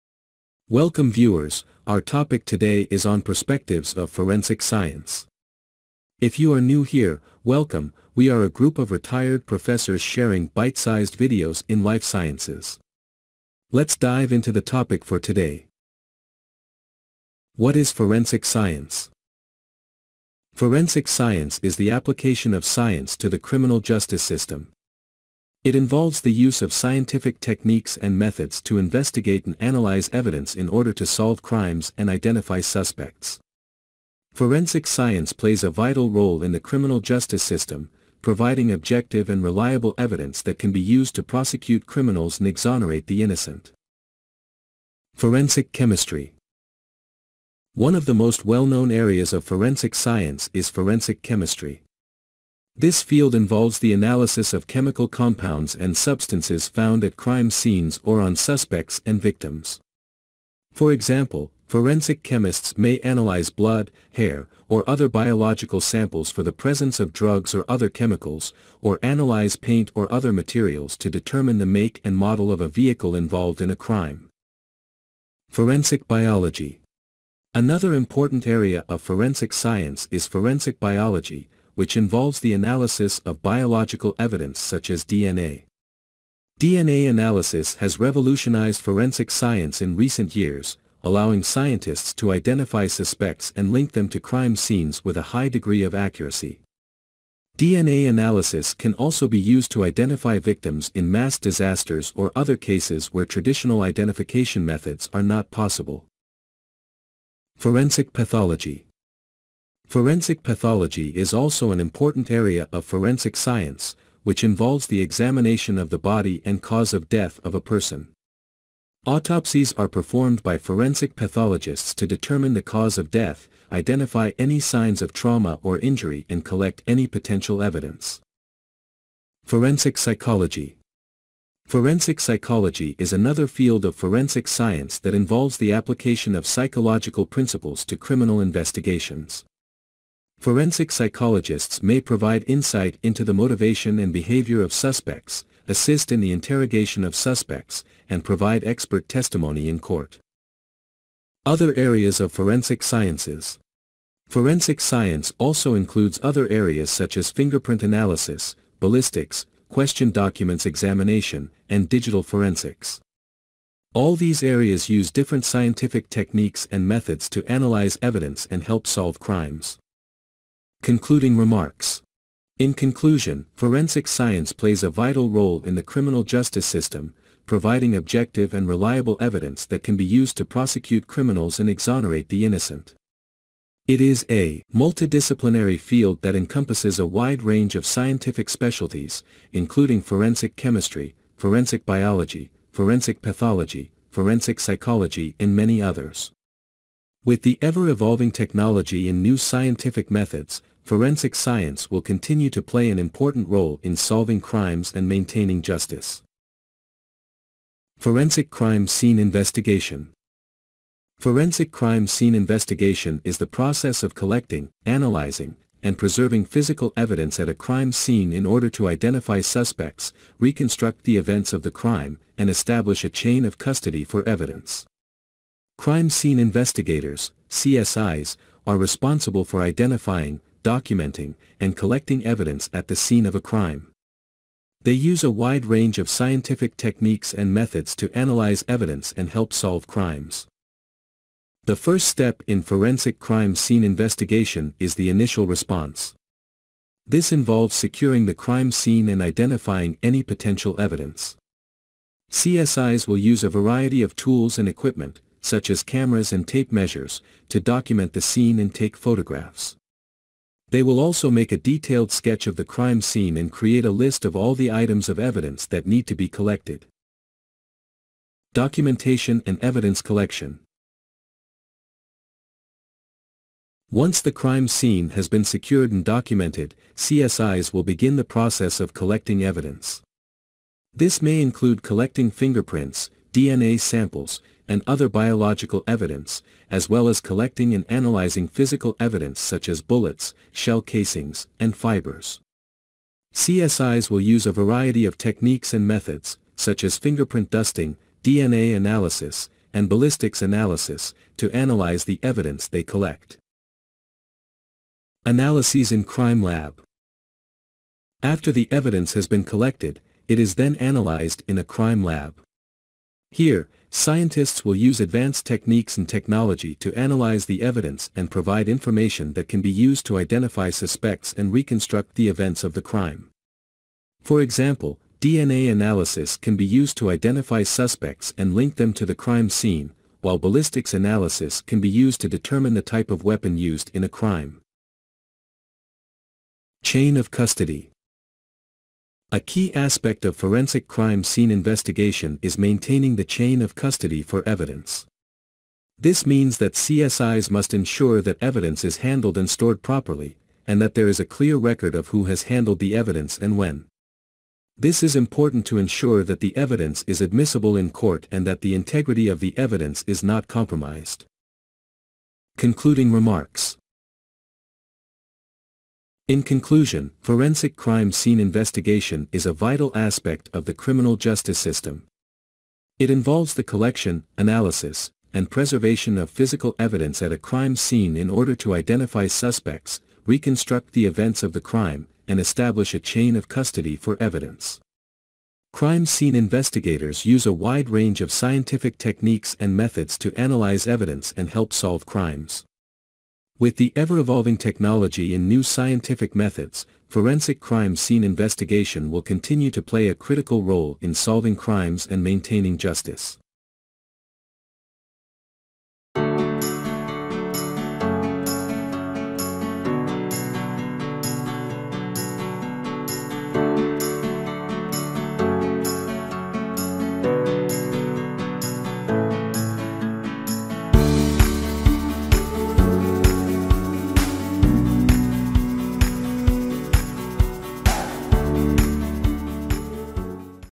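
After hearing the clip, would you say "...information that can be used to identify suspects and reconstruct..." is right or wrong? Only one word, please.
right.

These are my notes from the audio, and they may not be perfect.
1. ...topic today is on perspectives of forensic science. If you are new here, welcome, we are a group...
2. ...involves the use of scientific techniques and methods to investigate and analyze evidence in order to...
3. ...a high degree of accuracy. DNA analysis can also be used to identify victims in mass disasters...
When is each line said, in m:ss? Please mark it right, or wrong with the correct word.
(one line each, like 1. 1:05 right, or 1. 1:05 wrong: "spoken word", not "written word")
1. 0:01 right
2. 0:25 right
3. 1:35 right.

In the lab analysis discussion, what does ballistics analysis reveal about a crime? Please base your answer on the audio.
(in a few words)
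Type of weapon.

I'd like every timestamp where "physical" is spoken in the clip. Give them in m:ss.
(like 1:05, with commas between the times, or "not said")
3:36, 4:48, 6:16.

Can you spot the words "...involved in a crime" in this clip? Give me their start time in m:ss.
1:13.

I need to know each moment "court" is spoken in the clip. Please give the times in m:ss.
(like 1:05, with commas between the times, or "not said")
2:29, 5:57.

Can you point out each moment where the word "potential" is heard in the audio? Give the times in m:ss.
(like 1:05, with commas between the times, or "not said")
2:07, 4:10.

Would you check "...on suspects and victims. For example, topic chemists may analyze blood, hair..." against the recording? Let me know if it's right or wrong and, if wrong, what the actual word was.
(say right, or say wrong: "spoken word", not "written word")
wrong: "forensic", not "topic".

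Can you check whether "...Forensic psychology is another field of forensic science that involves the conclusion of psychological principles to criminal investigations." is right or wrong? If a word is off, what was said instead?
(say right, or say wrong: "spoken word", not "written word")
wrong: "application", not "conclusion".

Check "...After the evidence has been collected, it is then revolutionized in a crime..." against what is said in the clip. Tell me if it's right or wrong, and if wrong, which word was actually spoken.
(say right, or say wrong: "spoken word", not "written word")
wrong: "analyzed", not "revolutionized".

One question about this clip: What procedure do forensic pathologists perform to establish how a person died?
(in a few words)
Autopsies.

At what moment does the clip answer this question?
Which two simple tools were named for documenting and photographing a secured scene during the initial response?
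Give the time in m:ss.
4:15.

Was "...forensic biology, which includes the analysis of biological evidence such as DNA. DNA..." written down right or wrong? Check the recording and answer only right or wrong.
wrong.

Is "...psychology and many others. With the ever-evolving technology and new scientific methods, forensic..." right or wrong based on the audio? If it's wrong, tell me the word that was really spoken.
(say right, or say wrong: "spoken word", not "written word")
right.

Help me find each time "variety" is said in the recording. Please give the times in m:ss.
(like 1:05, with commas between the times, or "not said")
4:13, 4:54.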